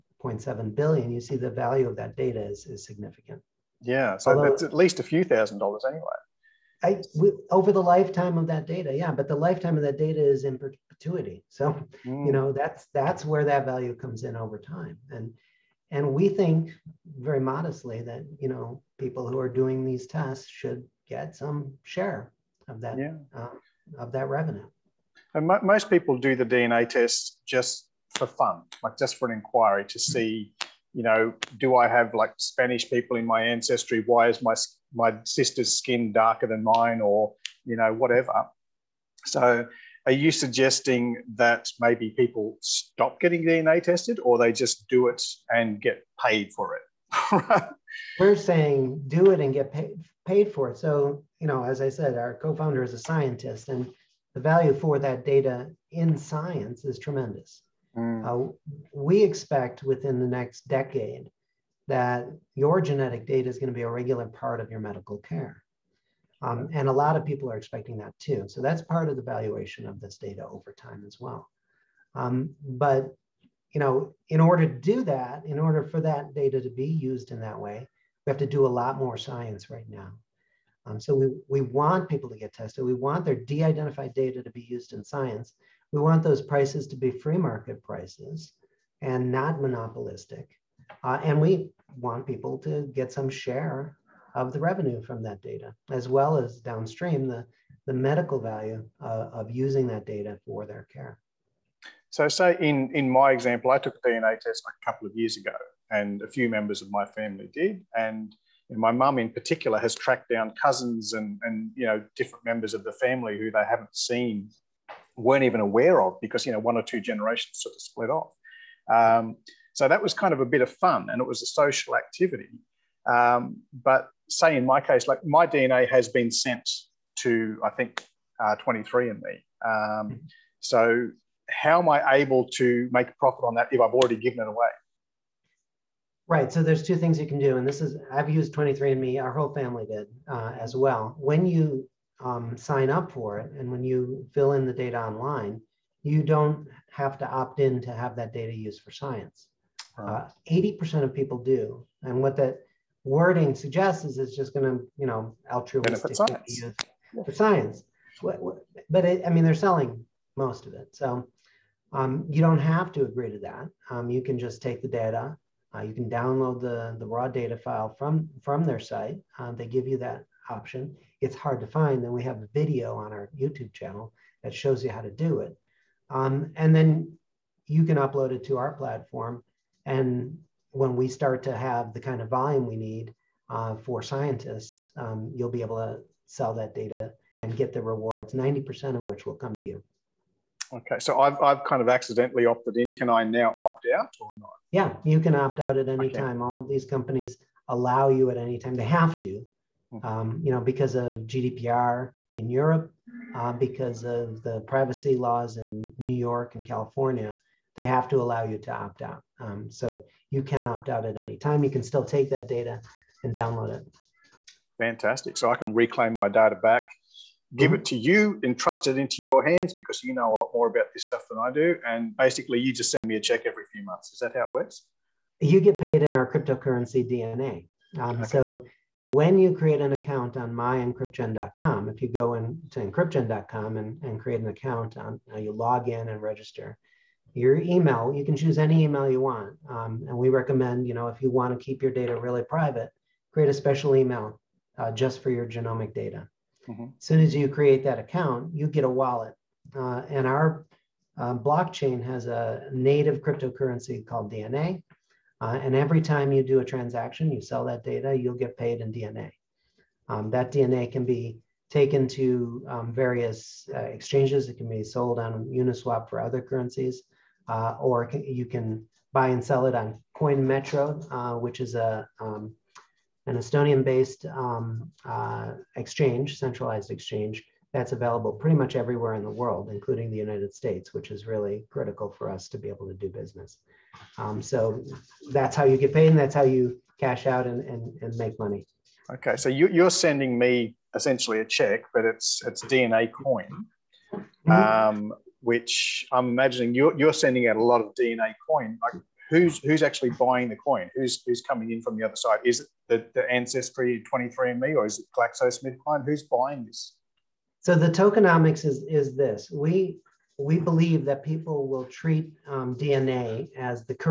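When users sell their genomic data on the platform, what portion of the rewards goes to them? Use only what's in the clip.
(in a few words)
90%.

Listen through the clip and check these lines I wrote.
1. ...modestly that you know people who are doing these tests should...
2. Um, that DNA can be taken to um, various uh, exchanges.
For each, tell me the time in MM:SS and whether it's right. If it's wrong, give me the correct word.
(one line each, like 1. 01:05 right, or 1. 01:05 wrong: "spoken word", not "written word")
1. 00:17 right
2. 04:20 right.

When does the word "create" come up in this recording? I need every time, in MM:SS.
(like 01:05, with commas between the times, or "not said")
03:49, 03:54, 04:03, 04:07.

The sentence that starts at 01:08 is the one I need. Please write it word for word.
So that's part of the valuation of this data over time as well.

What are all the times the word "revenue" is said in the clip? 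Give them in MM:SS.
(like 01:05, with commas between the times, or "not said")
00:24, 01:34.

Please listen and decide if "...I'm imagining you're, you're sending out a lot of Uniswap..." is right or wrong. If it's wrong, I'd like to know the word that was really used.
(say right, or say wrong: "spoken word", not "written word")
wrong: "DNA", not "Uniswap".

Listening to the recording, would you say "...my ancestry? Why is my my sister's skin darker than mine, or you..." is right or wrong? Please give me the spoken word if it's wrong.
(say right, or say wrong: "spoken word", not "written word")
right.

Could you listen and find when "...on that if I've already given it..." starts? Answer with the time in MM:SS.
02:13.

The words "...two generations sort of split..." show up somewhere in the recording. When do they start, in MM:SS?
01:56.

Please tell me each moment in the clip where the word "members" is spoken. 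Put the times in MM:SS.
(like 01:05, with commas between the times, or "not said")
01:46, 01:52.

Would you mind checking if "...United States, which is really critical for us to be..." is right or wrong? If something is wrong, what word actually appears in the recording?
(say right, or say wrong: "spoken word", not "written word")
right.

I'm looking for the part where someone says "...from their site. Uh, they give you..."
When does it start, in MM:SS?
02:48.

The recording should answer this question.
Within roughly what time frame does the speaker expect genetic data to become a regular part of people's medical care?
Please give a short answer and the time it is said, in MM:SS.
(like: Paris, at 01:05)
the next decade, at 00:59.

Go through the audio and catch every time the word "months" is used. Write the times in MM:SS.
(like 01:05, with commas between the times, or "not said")
03:43.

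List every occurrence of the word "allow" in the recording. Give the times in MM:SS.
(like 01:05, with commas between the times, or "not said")
03:17, 03:28.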